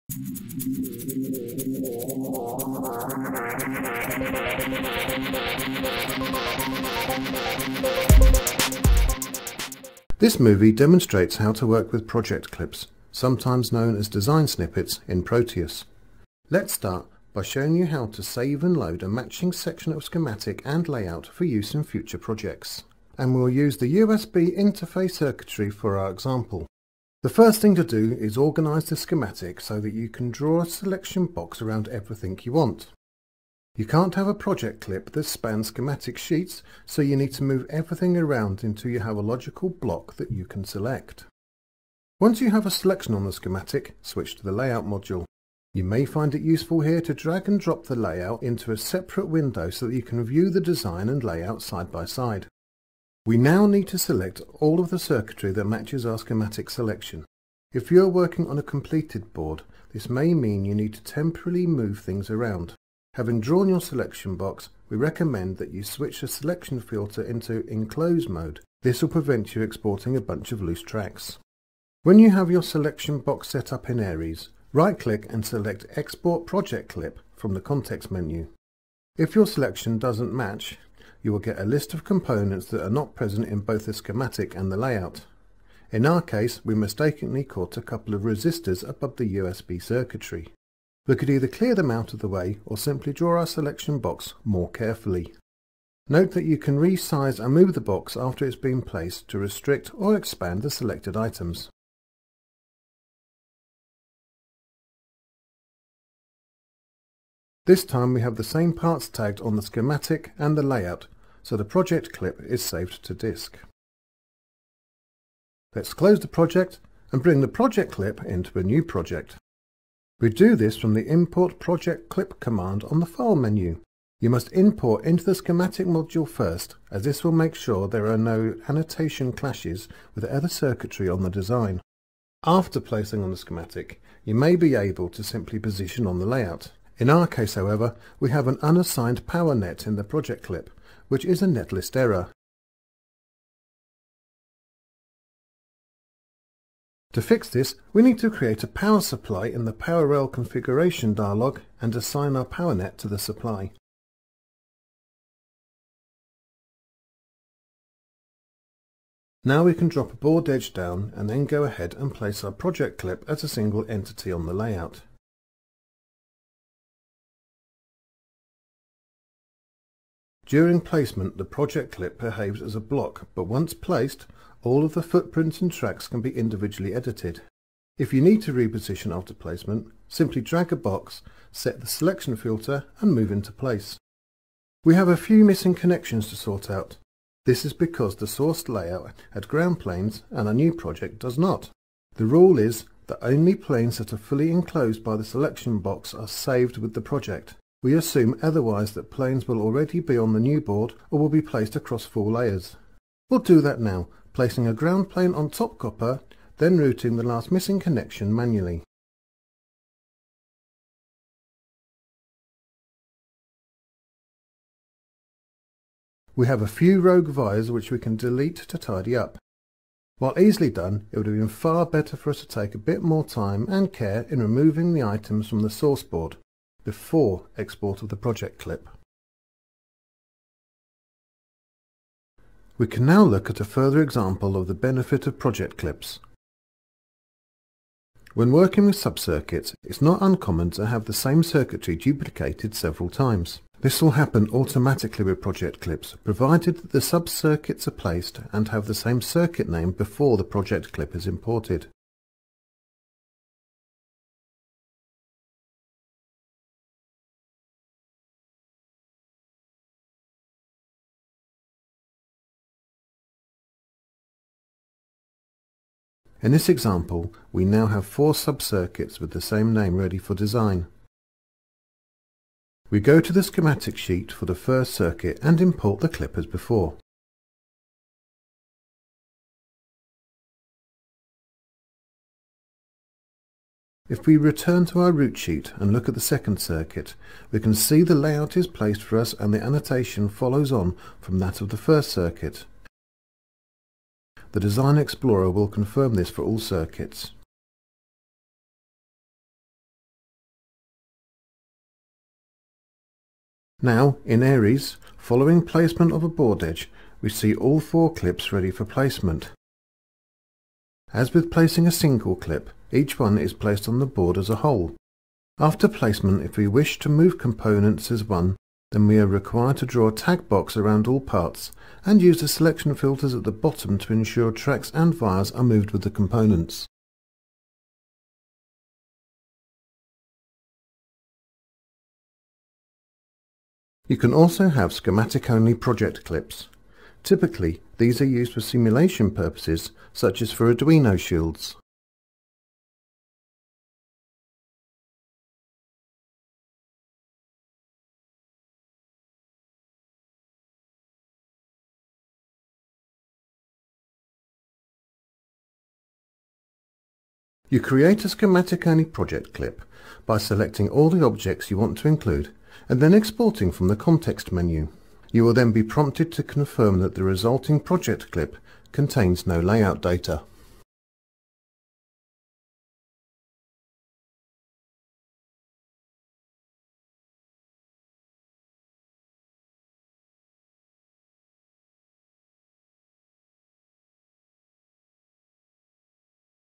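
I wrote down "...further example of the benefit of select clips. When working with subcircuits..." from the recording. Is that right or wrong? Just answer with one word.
wrong.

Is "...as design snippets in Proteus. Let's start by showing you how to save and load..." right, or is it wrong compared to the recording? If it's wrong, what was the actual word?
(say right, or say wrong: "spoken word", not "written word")
right.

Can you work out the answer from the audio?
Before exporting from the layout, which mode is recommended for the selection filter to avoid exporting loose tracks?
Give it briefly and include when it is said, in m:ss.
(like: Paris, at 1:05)
enclose mode, at 1:07.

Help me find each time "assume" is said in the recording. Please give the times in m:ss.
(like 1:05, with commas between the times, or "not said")
3:17.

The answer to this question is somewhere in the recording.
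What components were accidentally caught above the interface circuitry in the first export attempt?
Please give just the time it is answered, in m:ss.
1:28.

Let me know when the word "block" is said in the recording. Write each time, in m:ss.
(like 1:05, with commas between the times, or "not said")
0:39, 2:52.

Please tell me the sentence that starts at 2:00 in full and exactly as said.
We do this from the import project clip command on the file menu.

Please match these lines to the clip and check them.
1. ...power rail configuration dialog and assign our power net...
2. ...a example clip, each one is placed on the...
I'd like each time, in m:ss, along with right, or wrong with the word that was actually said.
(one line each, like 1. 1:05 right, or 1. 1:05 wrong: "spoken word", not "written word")
1. 2:29 right
2. 5:11 wrong: "single", not "example".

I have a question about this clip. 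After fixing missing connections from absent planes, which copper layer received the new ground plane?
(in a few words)
top copper.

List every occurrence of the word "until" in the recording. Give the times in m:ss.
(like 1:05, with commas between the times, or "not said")
0:38.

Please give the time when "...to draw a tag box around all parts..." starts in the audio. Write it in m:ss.
5:19.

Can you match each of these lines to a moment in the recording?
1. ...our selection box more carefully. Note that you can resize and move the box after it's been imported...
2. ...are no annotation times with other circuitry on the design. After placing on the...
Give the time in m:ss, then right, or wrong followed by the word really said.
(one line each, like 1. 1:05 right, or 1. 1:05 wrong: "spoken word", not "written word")
1. 1:33 wrong: "placed", not "imported"
2. 2:08 wrong: "clashes", not "times".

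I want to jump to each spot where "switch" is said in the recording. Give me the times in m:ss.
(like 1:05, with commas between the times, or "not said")
0:44, 1:05.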